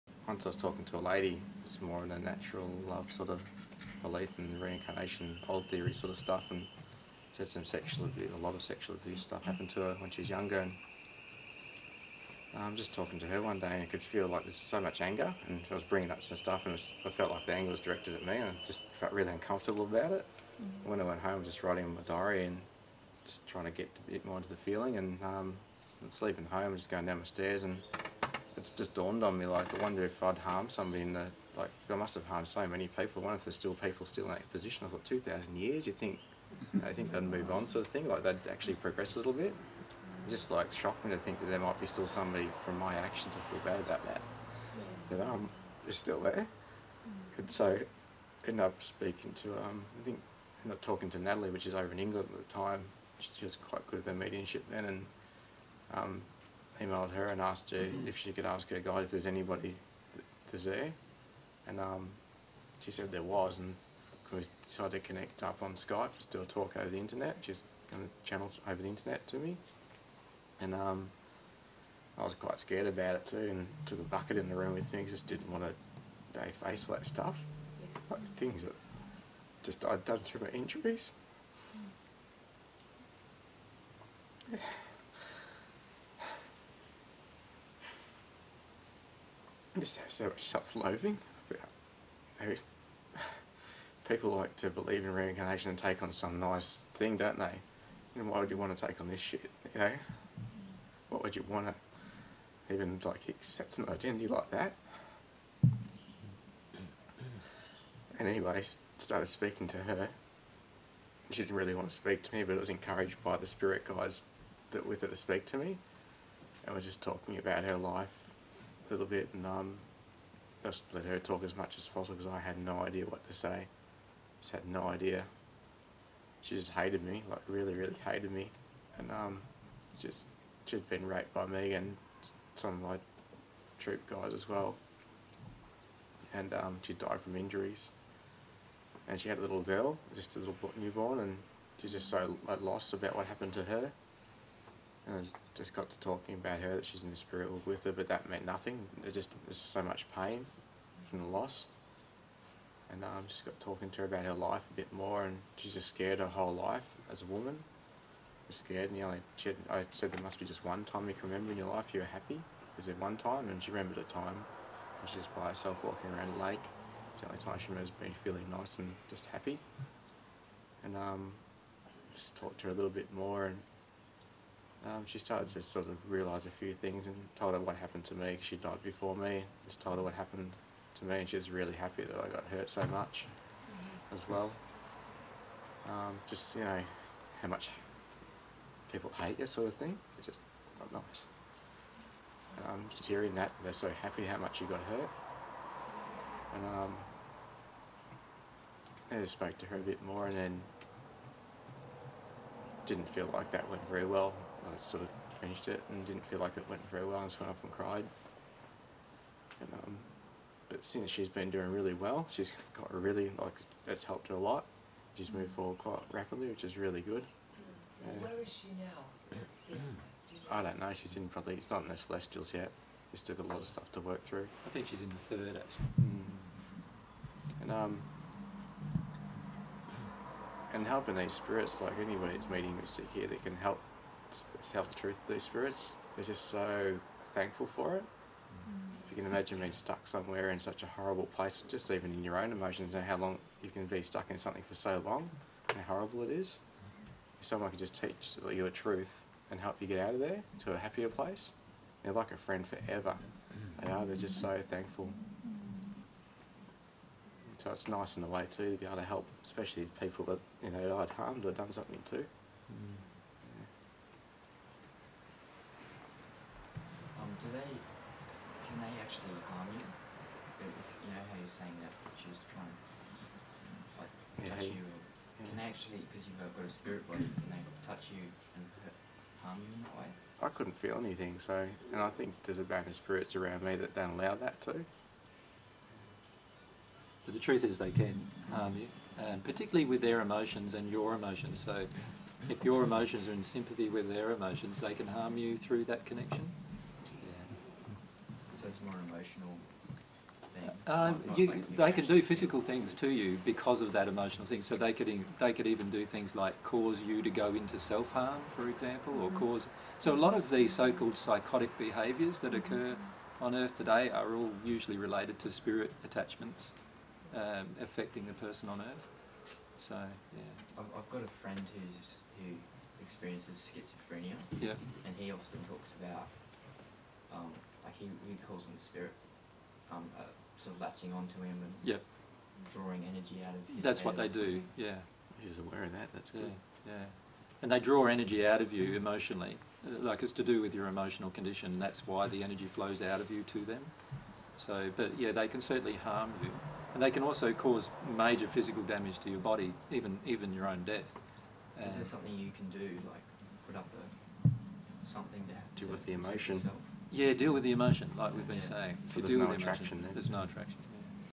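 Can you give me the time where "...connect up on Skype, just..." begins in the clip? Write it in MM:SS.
01:04.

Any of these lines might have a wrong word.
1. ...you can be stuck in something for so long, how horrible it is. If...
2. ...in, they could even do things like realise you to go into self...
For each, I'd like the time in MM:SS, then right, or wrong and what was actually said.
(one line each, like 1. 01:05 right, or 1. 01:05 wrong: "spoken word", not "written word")
1. 04:03 right
2. 05:05 wrong: "cause", not "realise".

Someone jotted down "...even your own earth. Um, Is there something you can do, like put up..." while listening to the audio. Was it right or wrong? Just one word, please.
wrong.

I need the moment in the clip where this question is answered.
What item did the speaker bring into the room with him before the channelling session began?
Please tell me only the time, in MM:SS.
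01:14.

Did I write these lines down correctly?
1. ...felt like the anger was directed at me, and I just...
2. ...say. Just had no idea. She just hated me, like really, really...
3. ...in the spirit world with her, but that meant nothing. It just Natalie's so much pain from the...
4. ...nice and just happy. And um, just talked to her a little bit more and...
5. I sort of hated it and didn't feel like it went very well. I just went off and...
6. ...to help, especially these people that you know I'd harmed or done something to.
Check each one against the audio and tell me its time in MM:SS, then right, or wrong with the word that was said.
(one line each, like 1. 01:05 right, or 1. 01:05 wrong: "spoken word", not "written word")
1. 00:17 right
2. 02:03 right
3. 02:27 wrong: "There", not "Natalie"
4. 02:48 right
5. 03:24 wrong: "finished", not "hated"
6. 04:18 right.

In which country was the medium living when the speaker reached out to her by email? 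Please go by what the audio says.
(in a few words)
England.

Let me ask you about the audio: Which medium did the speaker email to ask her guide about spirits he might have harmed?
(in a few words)
Natalie.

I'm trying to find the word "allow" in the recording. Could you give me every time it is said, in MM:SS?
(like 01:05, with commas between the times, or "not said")
04:44.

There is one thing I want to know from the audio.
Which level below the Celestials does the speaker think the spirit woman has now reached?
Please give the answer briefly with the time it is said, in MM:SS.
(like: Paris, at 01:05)
The third, at 03:45.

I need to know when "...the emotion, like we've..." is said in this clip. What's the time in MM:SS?
05:57.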